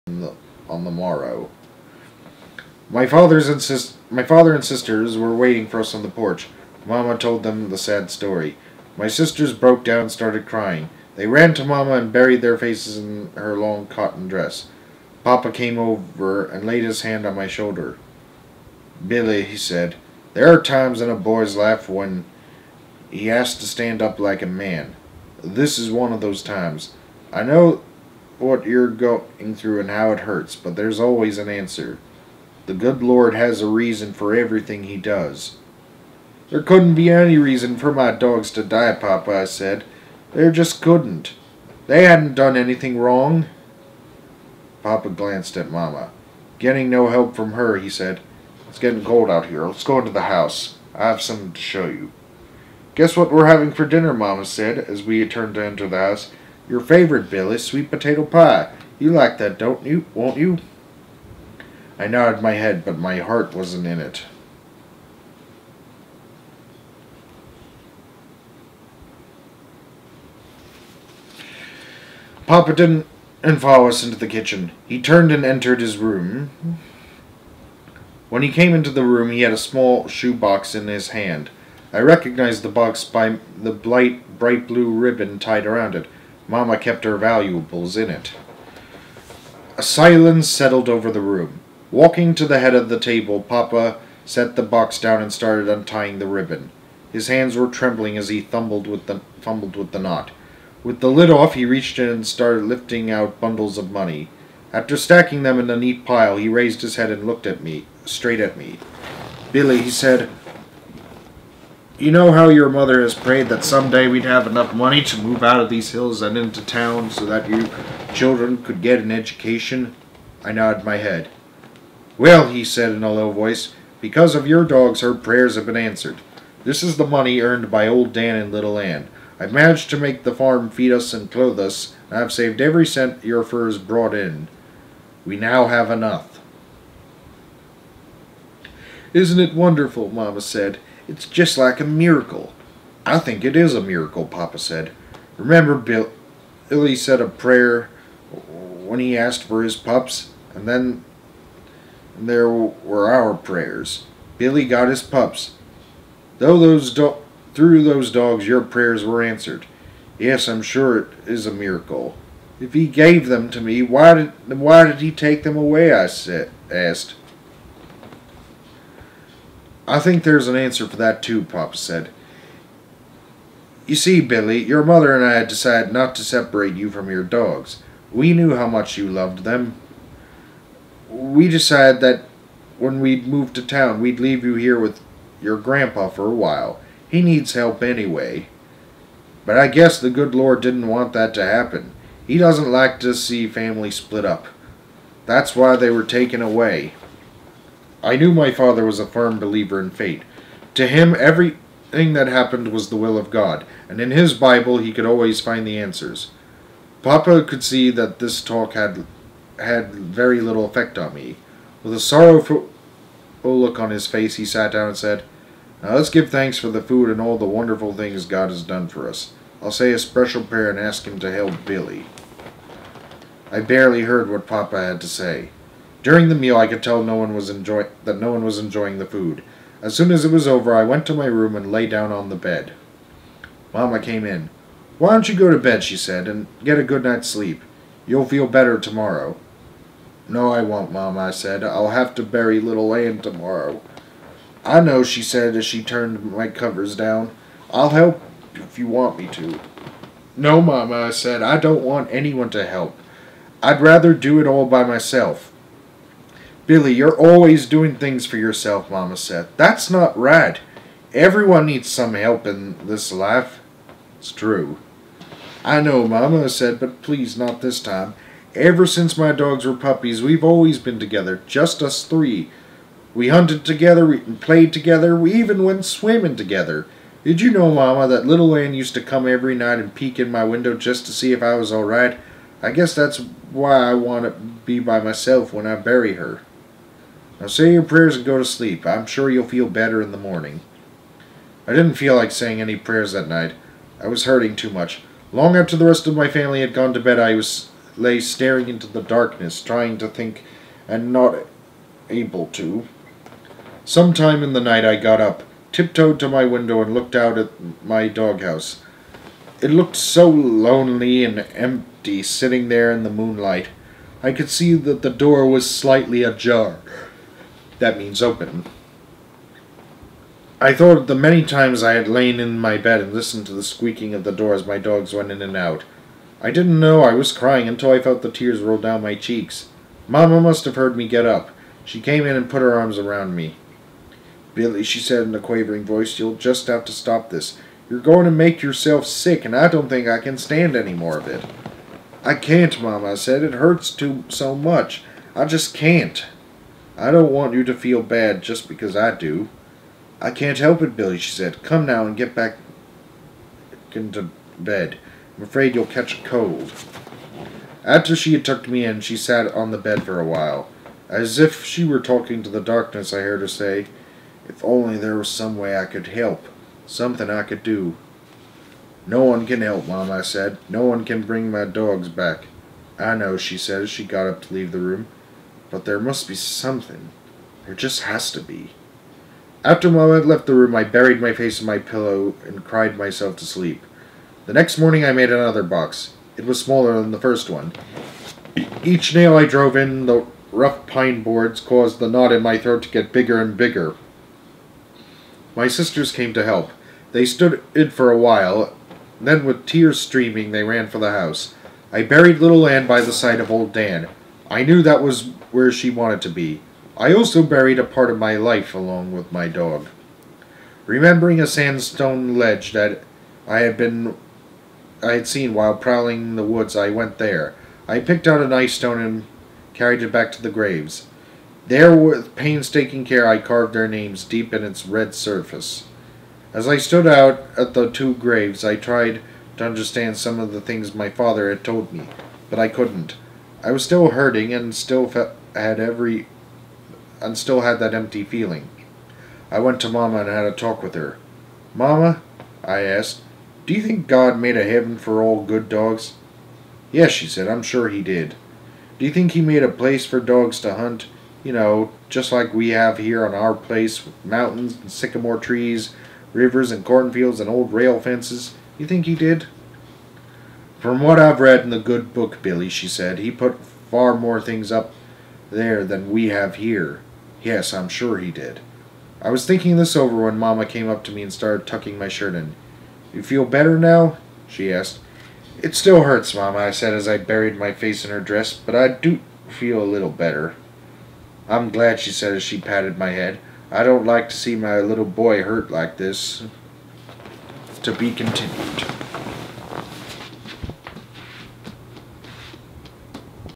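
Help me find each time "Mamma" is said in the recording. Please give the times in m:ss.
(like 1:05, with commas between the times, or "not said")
2:20, 5:30, 5:42.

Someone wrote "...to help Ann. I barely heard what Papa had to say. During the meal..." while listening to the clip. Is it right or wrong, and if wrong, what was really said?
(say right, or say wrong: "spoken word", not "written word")
wrong: "Billy", not "Ann".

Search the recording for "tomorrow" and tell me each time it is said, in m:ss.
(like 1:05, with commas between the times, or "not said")
3:58, 4:03.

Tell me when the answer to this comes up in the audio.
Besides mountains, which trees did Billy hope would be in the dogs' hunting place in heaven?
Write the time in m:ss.
7:34.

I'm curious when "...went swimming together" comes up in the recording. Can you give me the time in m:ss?
4:35.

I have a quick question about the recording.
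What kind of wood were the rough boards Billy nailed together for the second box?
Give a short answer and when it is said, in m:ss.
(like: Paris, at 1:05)
Pine, at 6:30.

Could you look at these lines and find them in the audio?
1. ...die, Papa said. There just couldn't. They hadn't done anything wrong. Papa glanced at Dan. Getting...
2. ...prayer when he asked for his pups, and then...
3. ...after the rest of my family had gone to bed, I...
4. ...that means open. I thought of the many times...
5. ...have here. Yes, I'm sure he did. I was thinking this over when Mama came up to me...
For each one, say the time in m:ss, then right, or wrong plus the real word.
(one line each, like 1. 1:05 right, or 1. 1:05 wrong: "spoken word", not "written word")
1. 0:38 wrong: "Mama", not "Dan"
2. 2:27 right
3. 4:55 right
4. 5:17 right
5. 7:46 right.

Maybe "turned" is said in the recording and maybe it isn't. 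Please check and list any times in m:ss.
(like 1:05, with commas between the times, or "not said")
0:55, 1:15, 4:05.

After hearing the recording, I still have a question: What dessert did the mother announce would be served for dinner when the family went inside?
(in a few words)
Sweet potato pie.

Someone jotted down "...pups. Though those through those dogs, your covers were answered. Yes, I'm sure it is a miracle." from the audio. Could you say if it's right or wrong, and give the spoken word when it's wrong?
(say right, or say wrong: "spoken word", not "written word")
wrong: "prayers", not "covers".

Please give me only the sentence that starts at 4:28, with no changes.
Ever since my dogs were puppies, we've always been together, just us three.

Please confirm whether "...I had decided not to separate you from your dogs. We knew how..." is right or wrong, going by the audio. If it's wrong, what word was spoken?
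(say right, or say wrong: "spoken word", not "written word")
right.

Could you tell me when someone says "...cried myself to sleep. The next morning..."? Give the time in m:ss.
6:22.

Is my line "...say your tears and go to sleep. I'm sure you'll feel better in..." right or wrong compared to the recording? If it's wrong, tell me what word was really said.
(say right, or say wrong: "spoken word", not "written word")
wrong: "prayers", not "tears".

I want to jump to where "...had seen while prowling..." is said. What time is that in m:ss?
6:55.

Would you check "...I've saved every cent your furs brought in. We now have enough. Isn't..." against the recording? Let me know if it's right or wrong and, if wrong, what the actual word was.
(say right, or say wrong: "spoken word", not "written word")
right.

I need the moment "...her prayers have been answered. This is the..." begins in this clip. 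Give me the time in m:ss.
2:05.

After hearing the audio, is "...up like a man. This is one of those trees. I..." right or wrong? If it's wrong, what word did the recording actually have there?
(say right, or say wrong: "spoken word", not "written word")
wrong: "times", not "trees".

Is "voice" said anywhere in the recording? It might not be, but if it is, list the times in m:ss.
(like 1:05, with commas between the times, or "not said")
2:03, 5:35.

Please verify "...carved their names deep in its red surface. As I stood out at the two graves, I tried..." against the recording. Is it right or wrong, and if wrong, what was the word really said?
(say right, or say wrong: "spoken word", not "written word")
right.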